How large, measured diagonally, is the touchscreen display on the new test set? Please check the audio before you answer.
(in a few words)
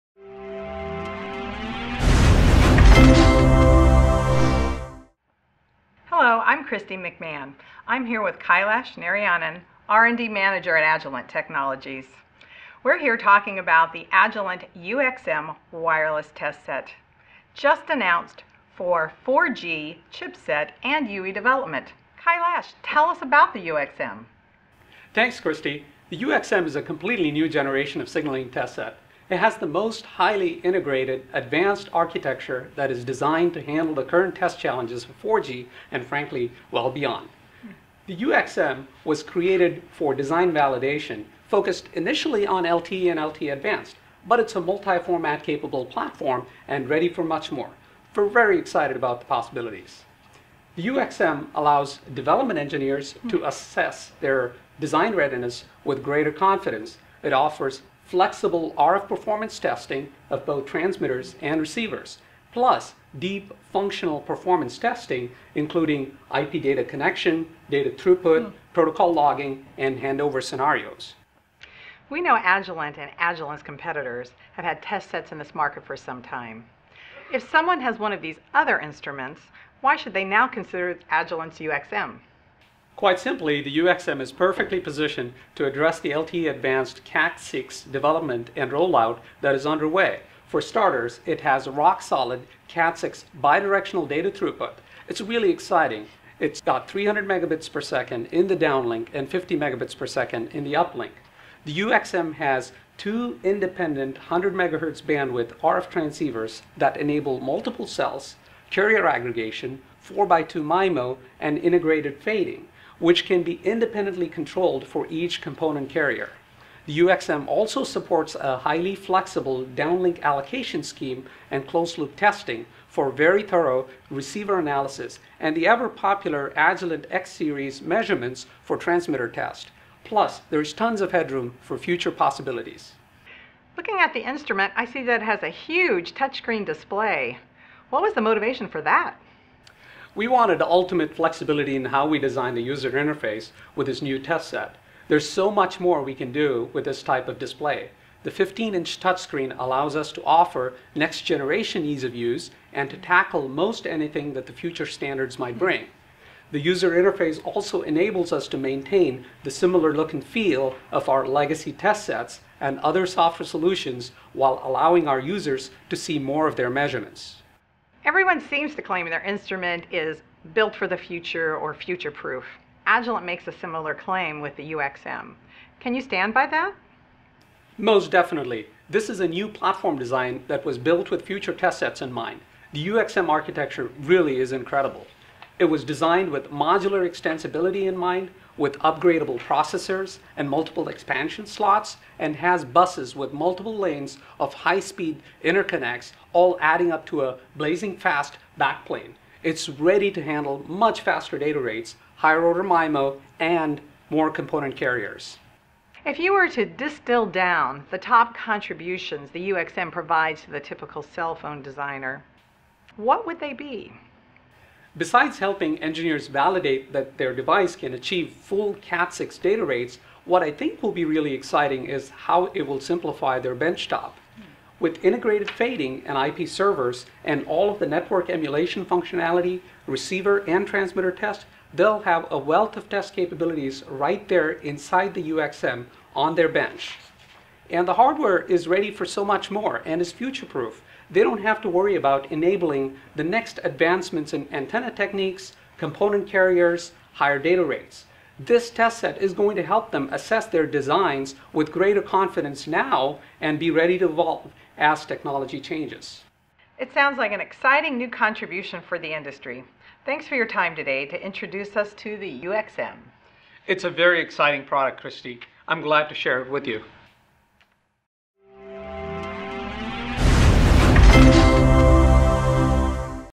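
15-inch.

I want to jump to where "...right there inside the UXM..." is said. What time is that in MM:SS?
03:53.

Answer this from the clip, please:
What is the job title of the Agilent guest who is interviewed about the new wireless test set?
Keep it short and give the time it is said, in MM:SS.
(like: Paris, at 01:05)
R&D Manager, at 00:09.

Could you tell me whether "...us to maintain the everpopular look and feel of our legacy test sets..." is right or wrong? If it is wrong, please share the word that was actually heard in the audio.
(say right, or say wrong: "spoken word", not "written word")
wrong: "similar", not "everpopular".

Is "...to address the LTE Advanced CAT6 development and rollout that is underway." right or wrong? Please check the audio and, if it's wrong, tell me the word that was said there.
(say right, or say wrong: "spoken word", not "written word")
right.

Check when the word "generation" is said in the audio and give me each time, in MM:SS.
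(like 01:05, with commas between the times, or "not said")
00:27, 02:30.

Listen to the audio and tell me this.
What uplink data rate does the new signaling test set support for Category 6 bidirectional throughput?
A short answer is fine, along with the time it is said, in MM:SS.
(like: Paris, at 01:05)
50 megabits per second, at 01:39.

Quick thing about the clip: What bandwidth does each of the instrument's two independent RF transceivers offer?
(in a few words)
100 megahertz.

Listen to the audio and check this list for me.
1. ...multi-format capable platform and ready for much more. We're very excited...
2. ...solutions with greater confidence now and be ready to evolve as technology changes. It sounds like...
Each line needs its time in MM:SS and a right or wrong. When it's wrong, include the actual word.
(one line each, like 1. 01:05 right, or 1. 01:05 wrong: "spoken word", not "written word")
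1. 00:44 right
2. 04:10 wrong: "designs", not "solutions".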